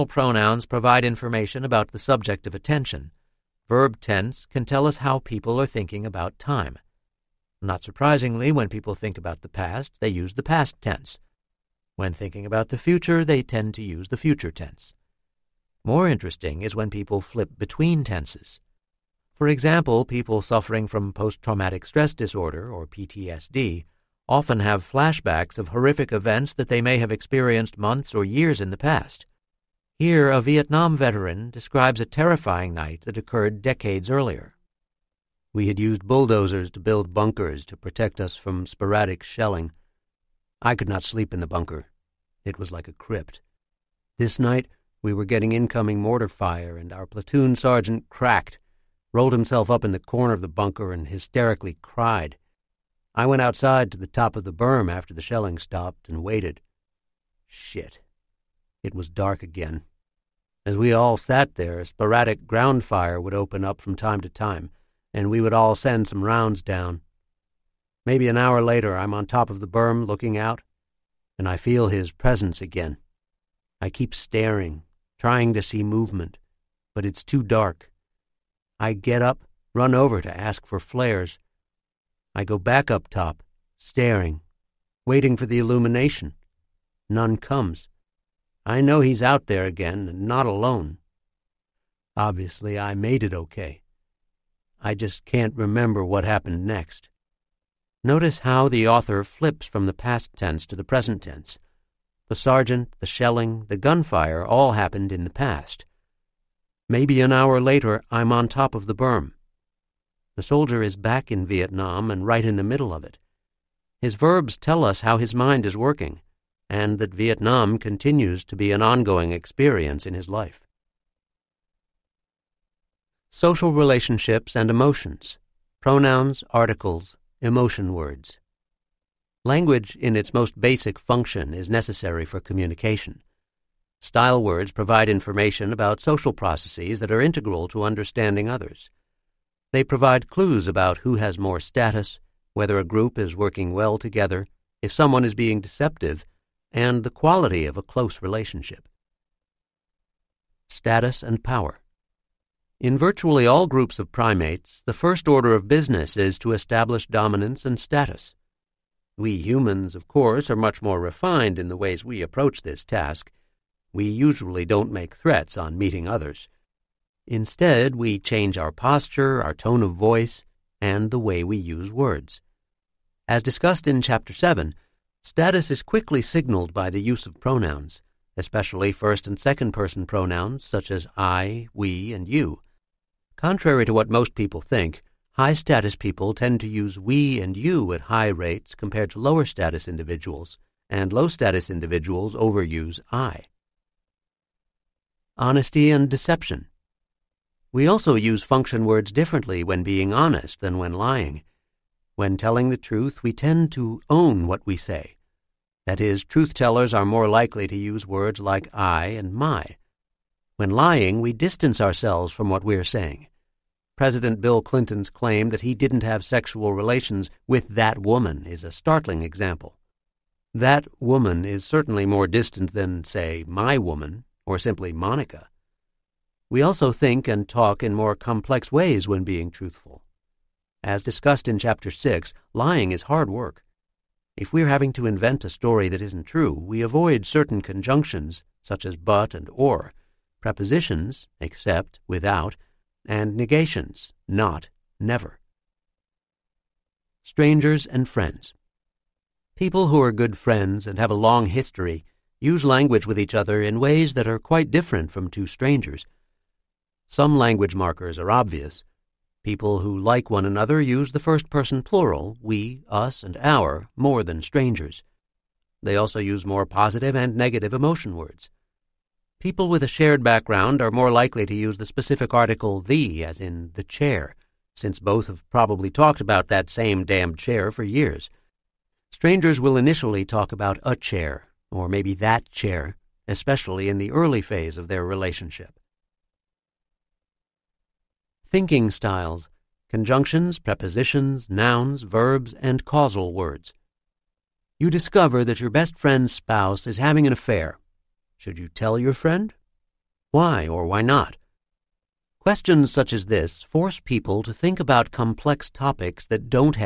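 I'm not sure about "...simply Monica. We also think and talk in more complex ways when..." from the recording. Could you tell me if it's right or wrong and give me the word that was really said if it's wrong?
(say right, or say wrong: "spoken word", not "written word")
right.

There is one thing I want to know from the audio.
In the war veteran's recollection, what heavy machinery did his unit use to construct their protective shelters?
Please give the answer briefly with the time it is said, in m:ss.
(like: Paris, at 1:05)
Bulldozers, at 0:36.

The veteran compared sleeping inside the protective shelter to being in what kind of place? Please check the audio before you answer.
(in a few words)
A crypt.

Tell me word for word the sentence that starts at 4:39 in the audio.
Strangers will initially talk about a chair, or maybe that chair, especially in the early phase of their relationship.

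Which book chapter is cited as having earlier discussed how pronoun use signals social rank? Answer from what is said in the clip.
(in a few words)
Chapter 7.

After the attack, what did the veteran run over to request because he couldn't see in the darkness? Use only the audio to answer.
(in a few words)
Flares.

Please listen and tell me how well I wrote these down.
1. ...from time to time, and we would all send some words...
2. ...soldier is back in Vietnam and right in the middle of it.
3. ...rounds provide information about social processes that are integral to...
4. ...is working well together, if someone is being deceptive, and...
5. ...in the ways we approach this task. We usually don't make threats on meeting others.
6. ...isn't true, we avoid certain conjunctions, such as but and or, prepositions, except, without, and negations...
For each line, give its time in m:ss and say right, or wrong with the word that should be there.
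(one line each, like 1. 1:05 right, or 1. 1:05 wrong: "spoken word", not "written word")
1. 1:03 wrong: "rounds", not "words"
2. 1:50 right
3. 2:14 wrong: "words", not "rounds"
4. 2:23 right
5. 2:41 right
6. 3:56 right.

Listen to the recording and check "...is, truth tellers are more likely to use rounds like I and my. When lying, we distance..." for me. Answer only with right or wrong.
wrong.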